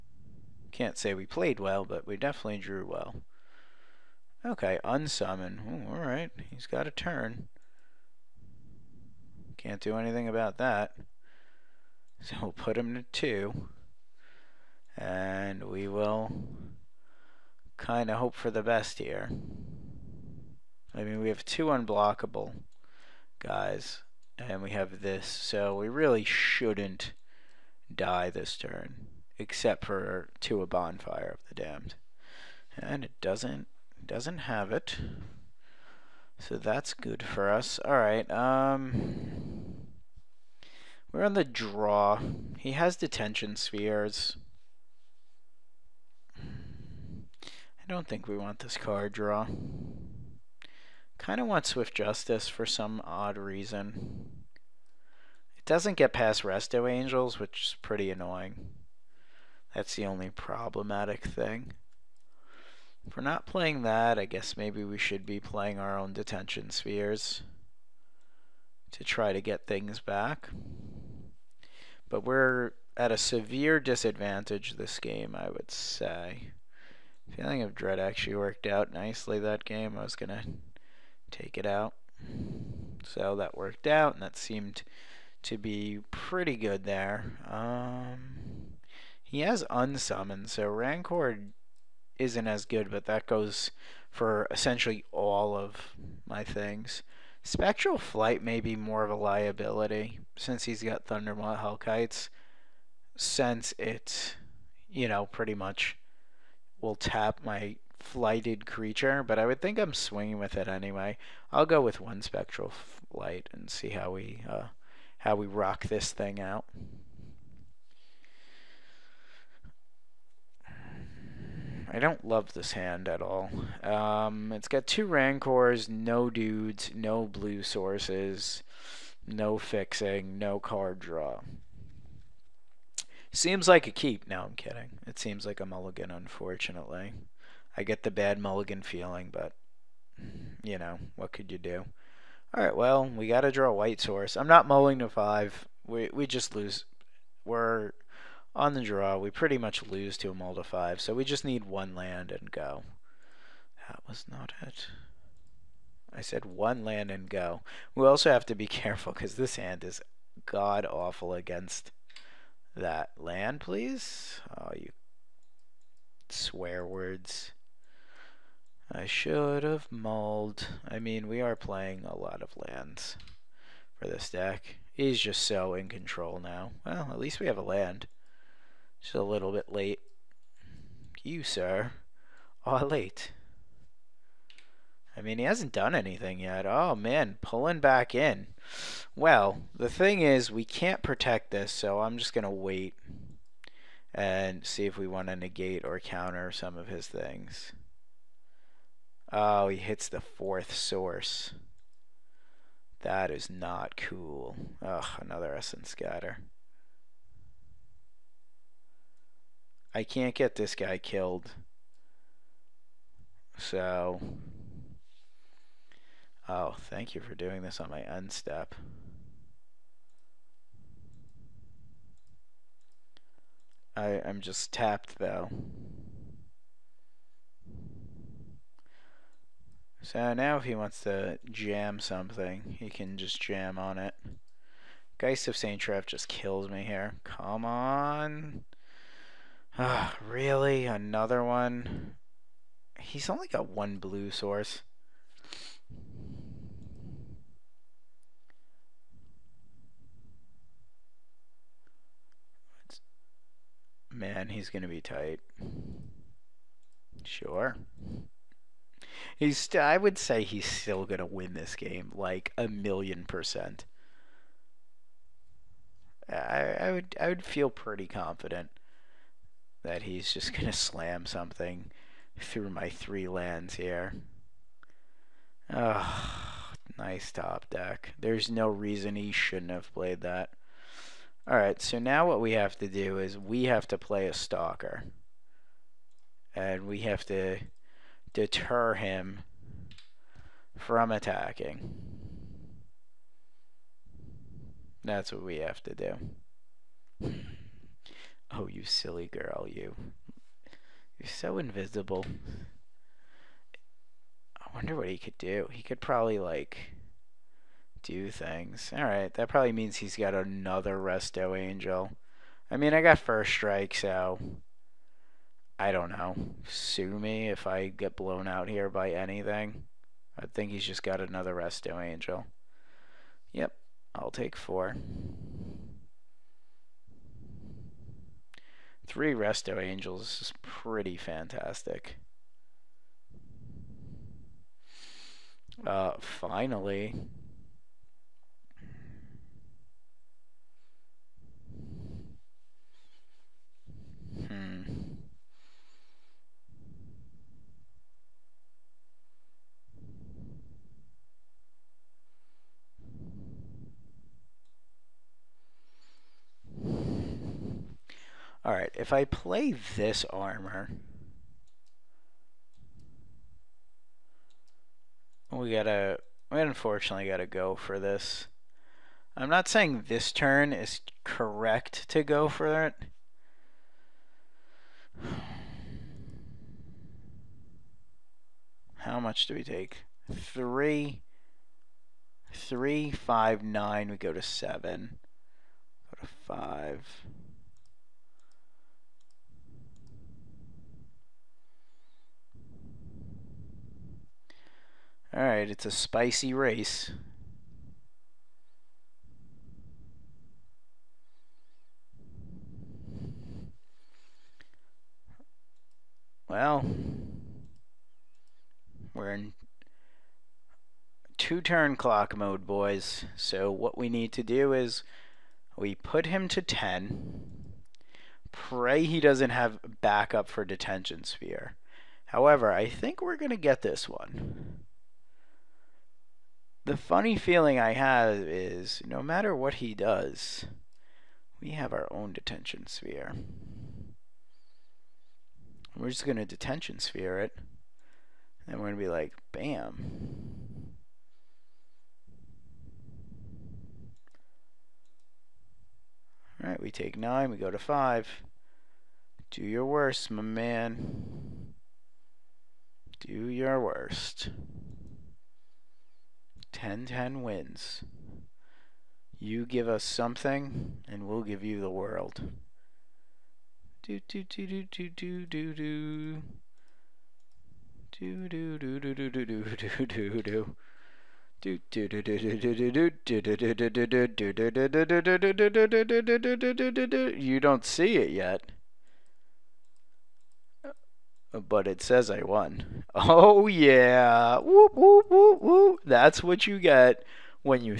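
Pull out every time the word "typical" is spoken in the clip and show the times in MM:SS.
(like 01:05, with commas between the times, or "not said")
not said.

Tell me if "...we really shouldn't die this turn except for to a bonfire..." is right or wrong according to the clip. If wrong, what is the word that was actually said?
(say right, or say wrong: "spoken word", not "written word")
right.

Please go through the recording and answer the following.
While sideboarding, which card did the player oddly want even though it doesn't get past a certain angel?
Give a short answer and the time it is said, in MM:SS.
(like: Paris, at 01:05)
Swift Justice, at 00:51.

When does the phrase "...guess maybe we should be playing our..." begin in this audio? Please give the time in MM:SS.
01:04.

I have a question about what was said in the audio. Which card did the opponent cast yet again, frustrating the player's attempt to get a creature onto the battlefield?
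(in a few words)
Essence Scatter.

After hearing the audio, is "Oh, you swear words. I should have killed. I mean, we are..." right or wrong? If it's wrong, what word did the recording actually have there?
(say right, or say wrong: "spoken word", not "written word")
wrong: "mulled", not "killed".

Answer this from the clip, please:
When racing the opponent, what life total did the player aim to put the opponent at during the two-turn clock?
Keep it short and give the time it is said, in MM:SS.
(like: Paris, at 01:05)
10, at 06:55.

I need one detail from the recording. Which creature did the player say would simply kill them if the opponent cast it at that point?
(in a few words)
Geist of St. Traft.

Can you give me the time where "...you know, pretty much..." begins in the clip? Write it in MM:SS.
01:44.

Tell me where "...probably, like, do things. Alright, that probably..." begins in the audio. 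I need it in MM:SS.
05:06.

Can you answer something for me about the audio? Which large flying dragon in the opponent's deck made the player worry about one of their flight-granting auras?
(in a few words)
Thundermaw Hellkites.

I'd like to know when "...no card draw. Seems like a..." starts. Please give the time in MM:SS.
02:10.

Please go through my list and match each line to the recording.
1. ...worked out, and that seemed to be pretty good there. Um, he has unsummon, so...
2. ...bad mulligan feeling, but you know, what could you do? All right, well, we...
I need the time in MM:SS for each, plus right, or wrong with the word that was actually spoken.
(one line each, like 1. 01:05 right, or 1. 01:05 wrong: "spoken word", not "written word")
1. 01:23 right
2. 02:18 right.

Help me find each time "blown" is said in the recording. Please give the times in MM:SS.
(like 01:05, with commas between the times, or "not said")
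05:18.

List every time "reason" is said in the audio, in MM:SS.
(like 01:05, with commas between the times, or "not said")
00:53, 04:38.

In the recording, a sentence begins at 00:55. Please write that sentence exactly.
It doesn't get past Resto Angels, which is pretty annoying.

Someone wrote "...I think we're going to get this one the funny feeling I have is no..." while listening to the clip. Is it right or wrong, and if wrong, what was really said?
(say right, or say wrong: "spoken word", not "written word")
right.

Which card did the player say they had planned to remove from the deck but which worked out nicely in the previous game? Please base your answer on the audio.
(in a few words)
Feeling of Dread.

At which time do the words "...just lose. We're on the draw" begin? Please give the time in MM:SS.
02:26.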